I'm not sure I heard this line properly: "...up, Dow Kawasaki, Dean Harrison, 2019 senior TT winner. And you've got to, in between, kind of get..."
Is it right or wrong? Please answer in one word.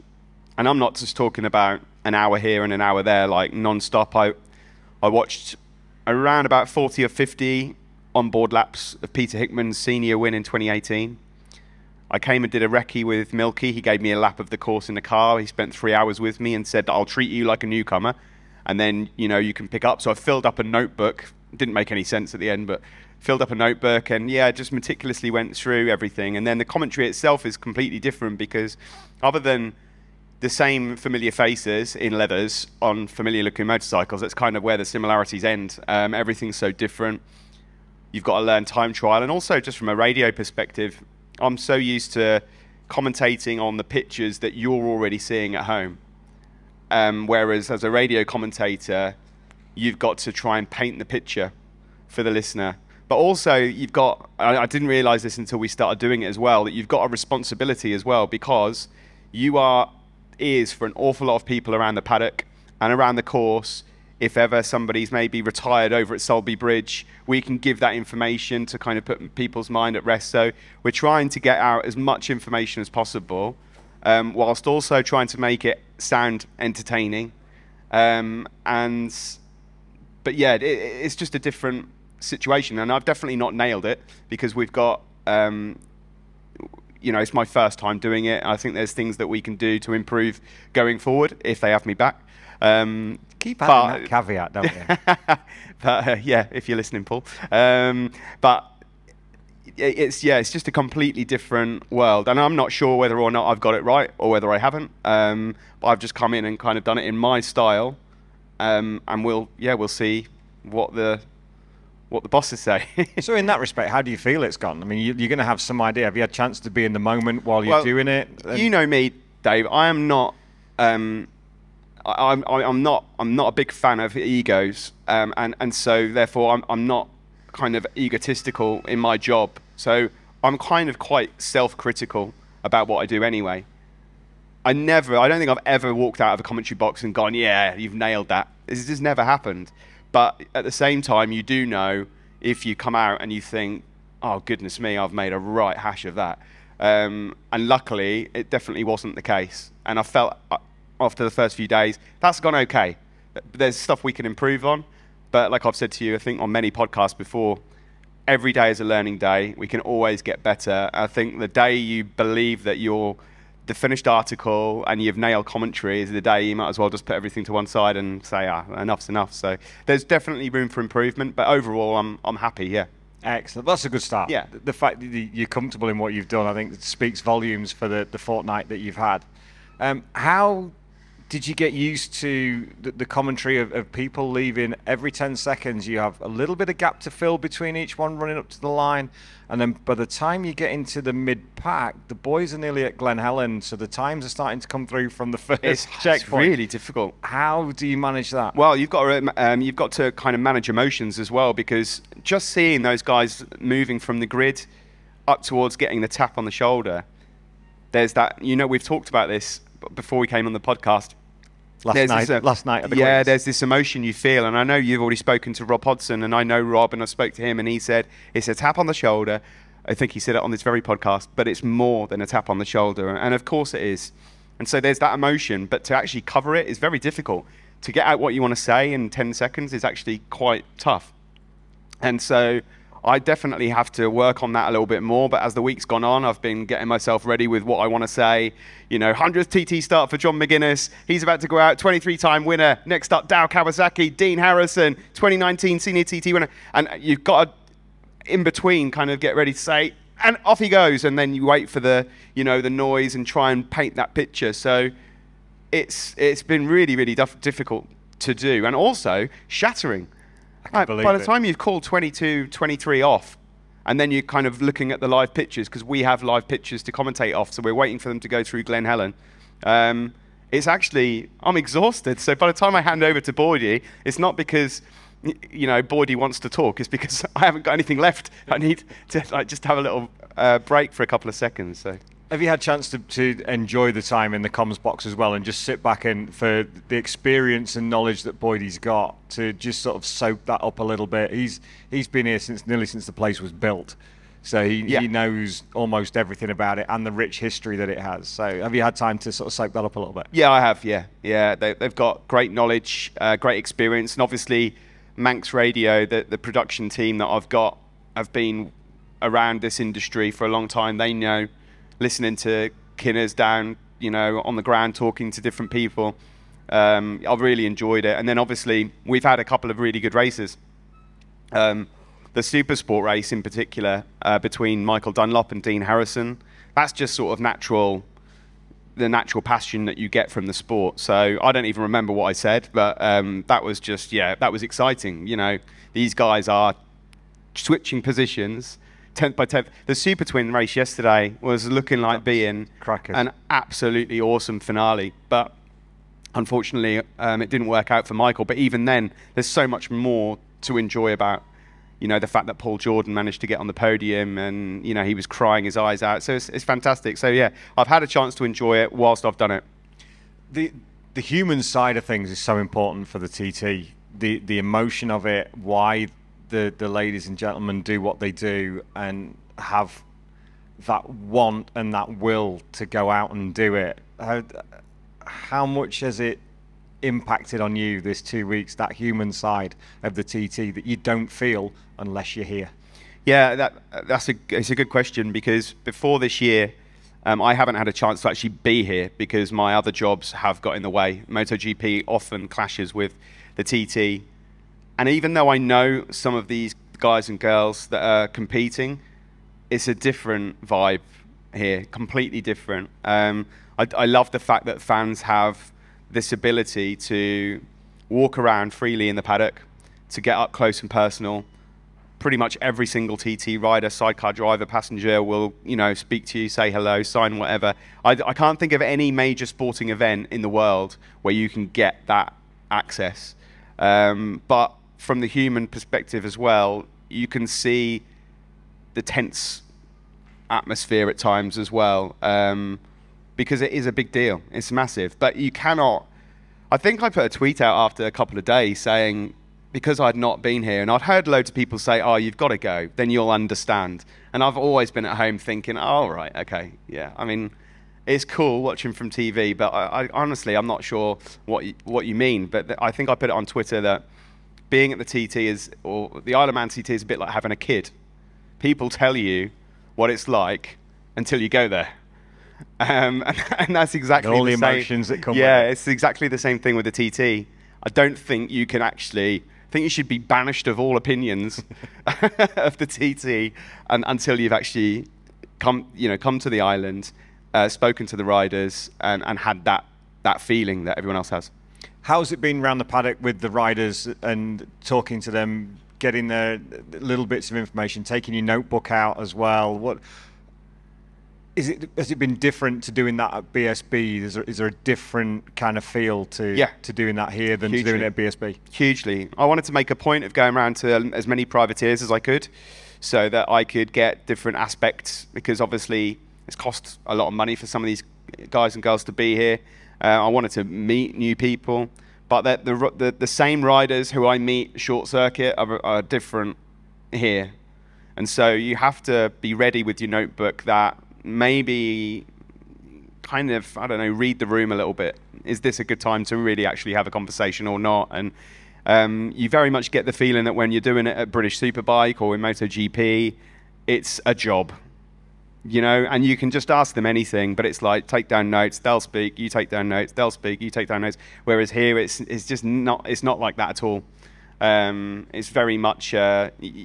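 right.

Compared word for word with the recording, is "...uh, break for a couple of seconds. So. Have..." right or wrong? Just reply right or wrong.
right.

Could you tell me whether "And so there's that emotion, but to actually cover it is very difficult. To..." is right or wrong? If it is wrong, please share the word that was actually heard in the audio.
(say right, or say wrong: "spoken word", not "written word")
right.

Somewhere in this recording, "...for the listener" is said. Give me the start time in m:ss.
0:52.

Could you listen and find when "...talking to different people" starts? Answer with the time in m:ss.
5:14.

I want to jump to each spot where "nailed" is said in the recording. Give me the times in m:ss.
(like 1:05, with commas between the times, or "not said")
1:23, 2:17, 2:45.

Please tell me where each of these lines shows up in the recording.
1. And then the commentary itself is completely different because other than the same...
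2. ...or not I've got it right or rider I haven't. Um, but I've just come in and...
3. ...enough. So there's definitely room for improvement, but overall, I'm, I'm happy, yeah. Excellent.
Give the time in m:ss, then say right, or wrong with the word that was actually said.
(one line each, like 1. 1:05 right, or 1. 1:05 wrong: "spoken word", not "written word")
1. 0:26 right
2. 1:43 wrong: "whether", not "rider"
3. 2:49 right.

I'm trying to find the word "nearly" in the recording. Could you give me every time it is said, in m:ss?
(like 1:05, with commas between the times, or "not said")
3:12, 4:52.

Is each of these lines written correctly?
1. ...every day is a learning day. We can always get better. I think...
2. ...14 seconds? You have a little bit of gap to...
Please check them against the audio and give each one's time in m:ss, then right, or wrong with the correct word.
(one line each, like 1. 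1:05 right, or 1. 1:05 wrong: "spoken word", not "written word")
1. 2:38 right
2. 3:05 wrong: "10", not "14".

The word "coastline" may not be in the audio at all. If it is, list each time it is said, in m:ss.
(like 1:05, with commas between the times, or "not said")
not said.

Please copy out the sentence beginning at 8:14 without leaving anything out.
Is there, is there a different kind of feel to yeah.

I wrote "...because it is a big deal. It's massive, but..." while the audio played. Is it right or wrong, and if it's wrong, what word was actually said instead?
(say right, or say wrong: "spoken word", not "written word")
right.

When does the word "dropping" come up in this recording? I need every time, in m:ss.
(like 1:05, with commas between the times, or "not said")
not said.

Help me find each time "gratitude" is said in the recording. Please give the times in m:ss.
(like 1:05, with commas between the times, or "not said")
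not said.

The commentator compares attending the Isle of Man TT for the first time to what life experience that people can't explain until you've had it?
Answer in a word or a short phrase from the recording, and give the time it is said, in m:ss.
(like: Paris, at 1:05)
having a kid, at 7:37.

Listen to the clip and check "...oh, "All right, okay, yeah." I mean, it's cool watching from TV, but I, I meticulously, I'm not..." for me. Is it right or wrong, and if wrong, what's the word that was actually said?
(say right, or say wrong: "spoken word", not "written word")
wrong: "honestly", not "meticulously".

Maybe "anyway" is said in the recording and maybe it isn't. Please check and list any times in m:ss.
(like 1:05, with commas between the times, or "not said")
2:13.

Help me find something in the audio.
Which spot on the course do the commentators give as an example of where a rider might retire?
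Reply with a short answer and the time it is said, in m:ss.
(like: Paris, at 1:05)
Sulby Bridge, at 1:06.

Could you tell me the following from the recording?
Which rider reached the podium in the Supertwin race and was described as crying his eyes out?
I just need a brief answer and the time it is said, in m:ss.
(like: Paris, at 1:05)
Paul Jordan, at 5:52.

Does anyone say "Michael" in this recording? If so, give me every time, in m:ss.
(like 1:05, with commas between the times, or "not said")
5:24, 5:48.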